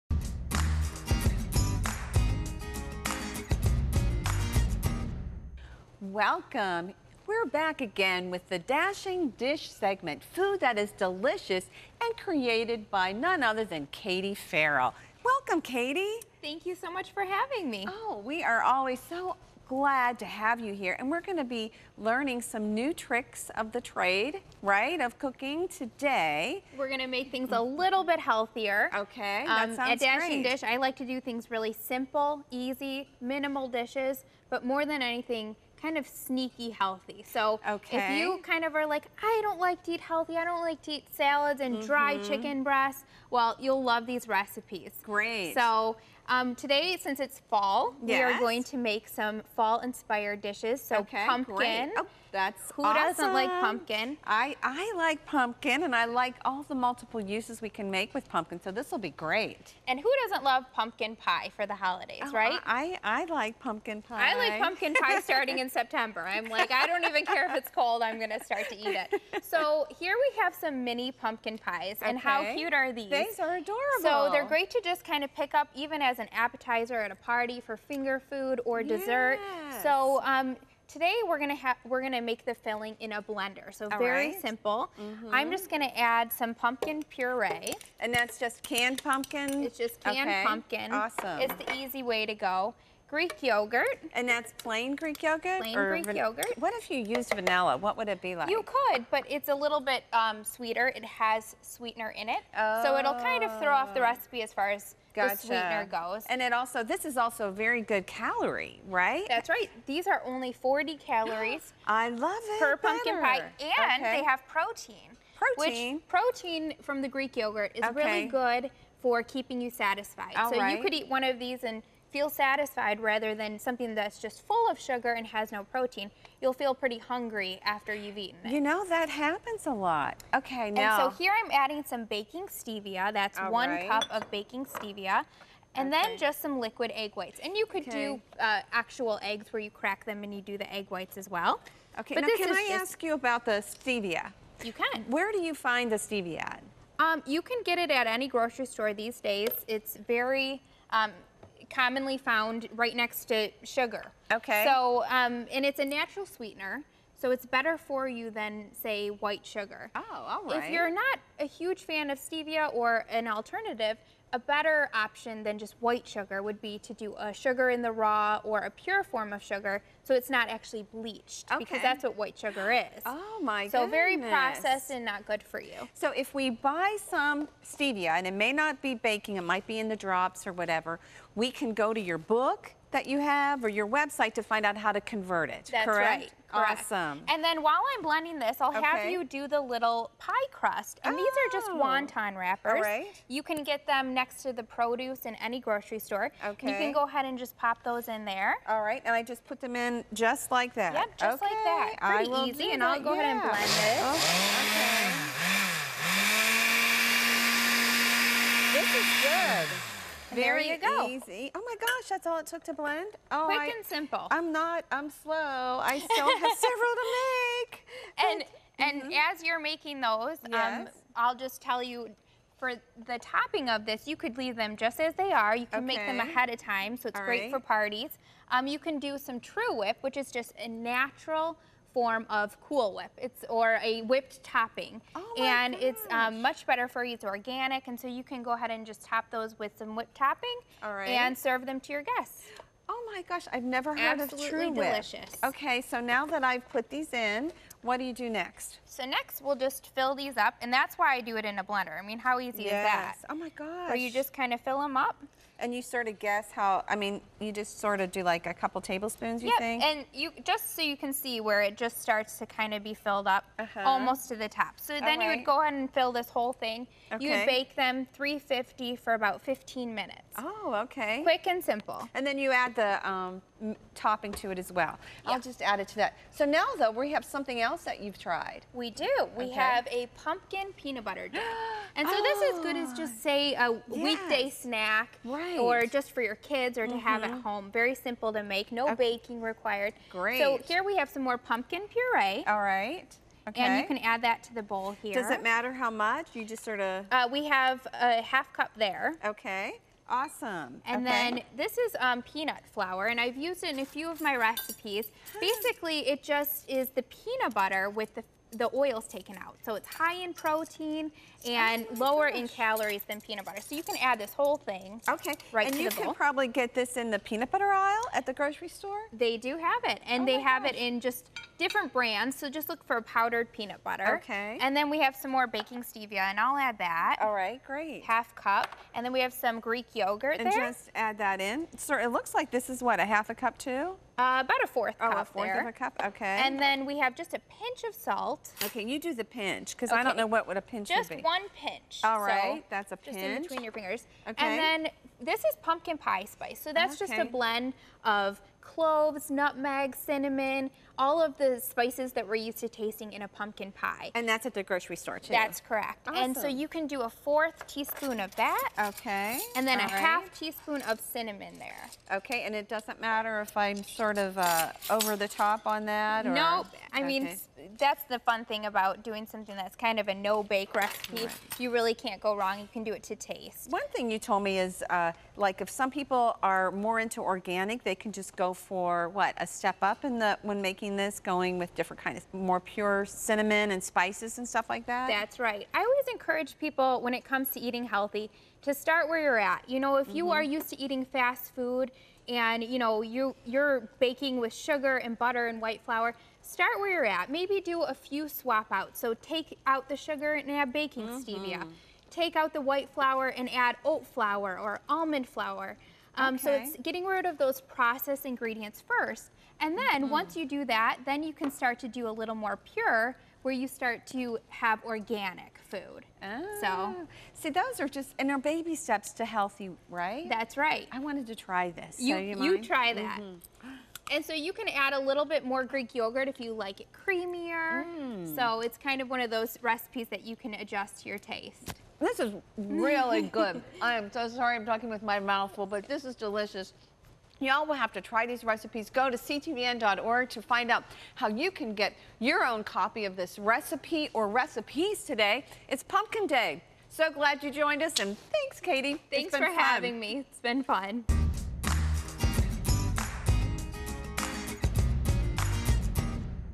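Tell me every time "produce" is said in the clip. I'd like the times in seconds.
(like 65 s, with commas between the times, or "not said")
194 s.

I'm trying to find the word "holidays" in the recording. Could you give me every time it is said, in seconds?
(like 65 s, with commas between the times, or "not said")
61 s.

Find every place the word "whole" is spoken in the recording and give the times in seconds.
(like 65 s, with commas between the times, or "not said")
266 s, 314 s.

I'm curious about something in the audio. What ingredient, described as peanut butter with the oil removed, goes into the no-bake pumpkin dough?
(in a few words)
Peanut flour.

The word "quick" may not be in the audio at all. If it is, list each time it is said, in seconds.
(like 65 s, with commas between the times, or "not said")
213 s, 271 s.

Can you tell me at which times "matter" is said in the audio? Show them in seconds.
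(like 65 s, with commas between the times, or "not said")
295 s, 363 s.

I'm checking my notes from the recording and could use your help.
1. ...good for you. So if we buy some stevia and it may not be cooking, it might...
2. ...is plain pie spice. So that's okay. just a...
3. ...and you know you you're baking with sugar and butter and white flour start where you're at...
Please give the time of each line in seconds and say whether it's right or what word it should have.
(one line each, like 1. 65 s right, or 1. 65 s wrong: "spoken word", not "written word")
1. 175 s wrong: "baking", not "cooking"
2. 345 s wrong: "pumpkin", not "plain"
3. 392 s right.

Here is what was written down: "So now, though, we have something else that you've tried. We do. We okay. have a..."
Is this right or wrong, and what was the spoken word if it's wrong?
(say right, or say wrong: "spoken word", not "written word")
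right.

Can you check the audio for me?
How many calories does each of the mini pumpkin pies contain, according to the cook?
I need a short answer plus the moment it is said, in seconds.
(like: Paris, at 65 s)
40, at 110 s.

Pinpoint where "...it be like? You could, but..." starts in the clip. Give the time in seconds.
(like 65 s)
98 s.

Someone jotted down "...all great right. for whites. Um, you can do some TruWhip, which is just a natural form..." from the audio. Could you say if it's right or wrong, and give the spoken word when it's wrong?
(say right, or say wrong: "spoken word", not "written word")
wrong: "parties", not "whites".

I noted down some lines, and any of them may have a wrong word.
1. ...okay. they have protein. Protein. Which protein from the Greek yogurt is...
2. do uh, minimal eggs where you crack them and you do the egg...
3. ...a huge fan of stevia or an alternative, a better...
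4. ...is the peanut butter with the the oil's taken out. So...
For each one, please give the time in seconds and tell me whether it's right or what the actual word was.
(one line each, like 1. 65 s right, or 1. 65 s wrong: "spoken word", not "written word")
1. 114 s right
2. 137 s wrong: "actual", not "minimal"
3. 161 s right
4. 306 s right.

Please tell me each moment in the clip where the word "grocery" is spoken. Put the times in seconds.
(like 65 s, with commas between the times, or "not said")
148 s, 195 s, 318 s, 354 s.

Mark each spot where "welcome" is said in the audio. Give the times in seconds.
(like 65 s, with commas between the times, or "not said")
6 s, 15 s.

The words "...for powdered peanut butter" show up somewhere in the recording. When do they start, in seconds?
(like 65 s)
322 s.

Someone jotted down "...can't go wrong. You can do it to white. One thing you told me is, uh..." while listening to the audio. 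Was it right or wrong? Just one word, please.
wrong.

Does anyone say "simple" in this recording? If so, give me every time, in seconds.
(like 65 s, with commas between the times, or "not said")
31 s, 84 s, 213 s, 271 s, 287 s.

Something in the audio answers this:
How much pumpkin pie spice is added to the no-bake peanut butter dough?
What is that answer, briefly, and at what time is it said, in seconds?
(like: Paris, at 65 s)
1/4 teaspoon, at 357 s.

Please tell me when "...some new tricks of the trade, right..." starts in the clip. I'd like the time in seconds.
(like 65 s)
22 s.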